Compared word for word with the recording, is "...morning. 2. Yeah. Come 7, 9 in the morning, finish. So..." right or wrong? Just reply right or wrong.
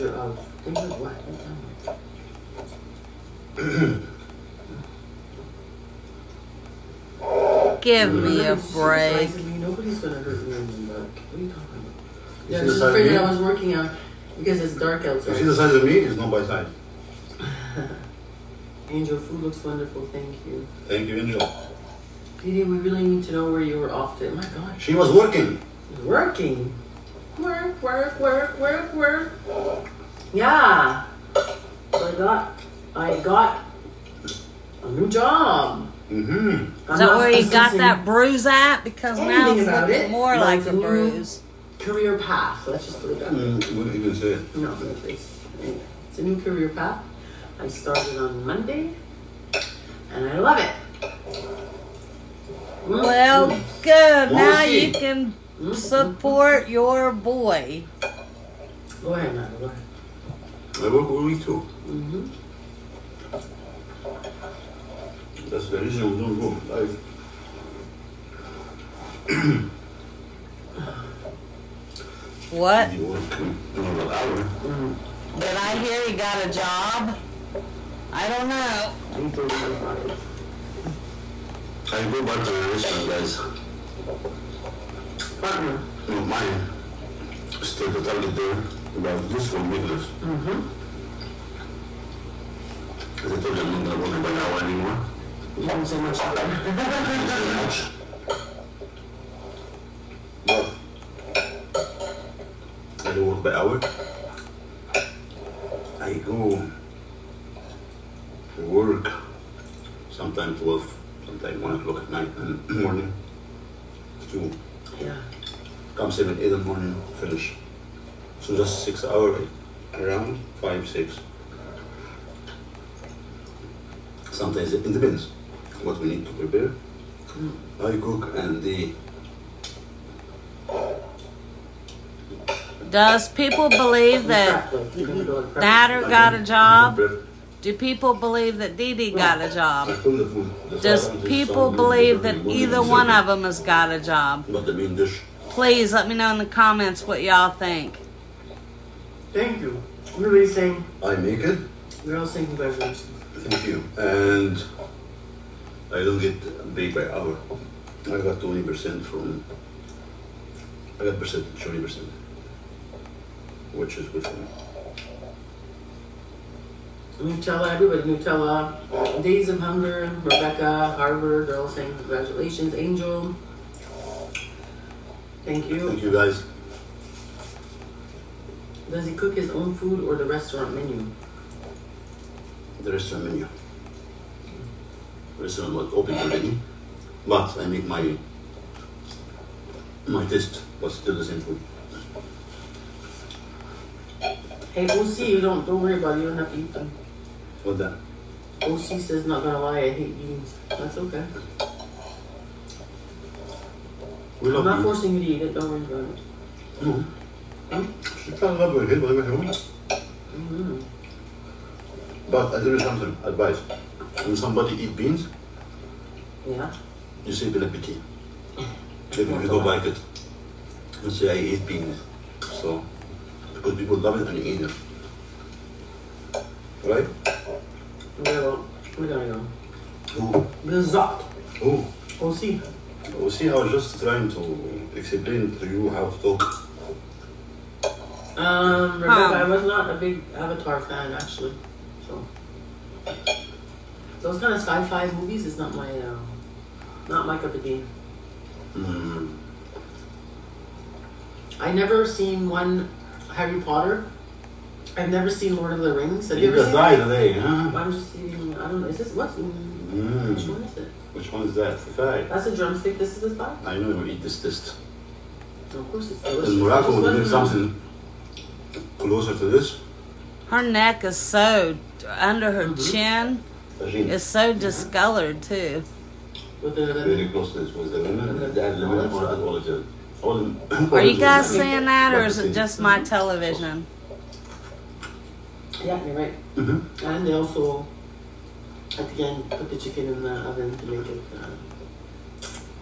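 wrong.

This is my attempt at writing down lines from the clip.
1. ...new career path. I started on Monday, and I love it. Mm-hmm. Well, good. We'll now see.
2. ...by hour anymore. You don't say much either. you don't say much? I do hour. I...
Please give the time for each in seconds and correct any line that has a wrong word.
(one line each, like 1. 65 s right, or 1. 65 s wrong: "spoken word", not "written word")
1. 46 s right
2. 94 s right.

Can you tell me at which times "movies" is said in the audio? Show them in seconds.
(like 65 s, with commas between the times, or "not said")
245 s.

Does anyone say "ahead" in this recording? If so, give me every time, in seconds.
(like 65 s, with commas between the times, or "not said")
59 s.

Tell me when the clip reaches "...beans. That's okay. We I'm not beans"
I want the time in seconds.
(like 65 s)
200 s.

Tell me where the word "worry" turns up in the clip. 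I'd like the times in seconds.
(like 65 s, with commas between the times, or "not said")
195 s, 205 s.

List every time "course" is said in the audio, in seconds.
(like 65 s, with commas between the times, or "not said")
265 s.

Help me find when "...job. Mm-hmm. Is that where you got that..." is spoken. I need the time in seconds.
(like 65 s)
35 s.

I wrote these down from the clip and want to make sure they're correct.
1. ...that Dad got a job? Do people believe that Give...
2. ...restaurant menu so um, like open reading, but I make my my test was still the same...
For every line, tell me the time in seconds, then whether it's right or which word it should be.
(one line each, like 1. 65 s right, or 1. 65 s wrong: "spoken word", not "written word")
1. 134 s wrong: "Dee", not "Give"
2. 182 s right.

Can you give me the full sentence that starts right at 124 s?
Sometimes it depends what we need to prepare.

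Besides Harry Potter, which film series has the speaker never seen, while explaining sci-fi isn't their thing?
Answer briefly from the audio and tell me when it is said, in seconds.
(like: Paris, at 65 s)
Lord of the Rings, at 255 s.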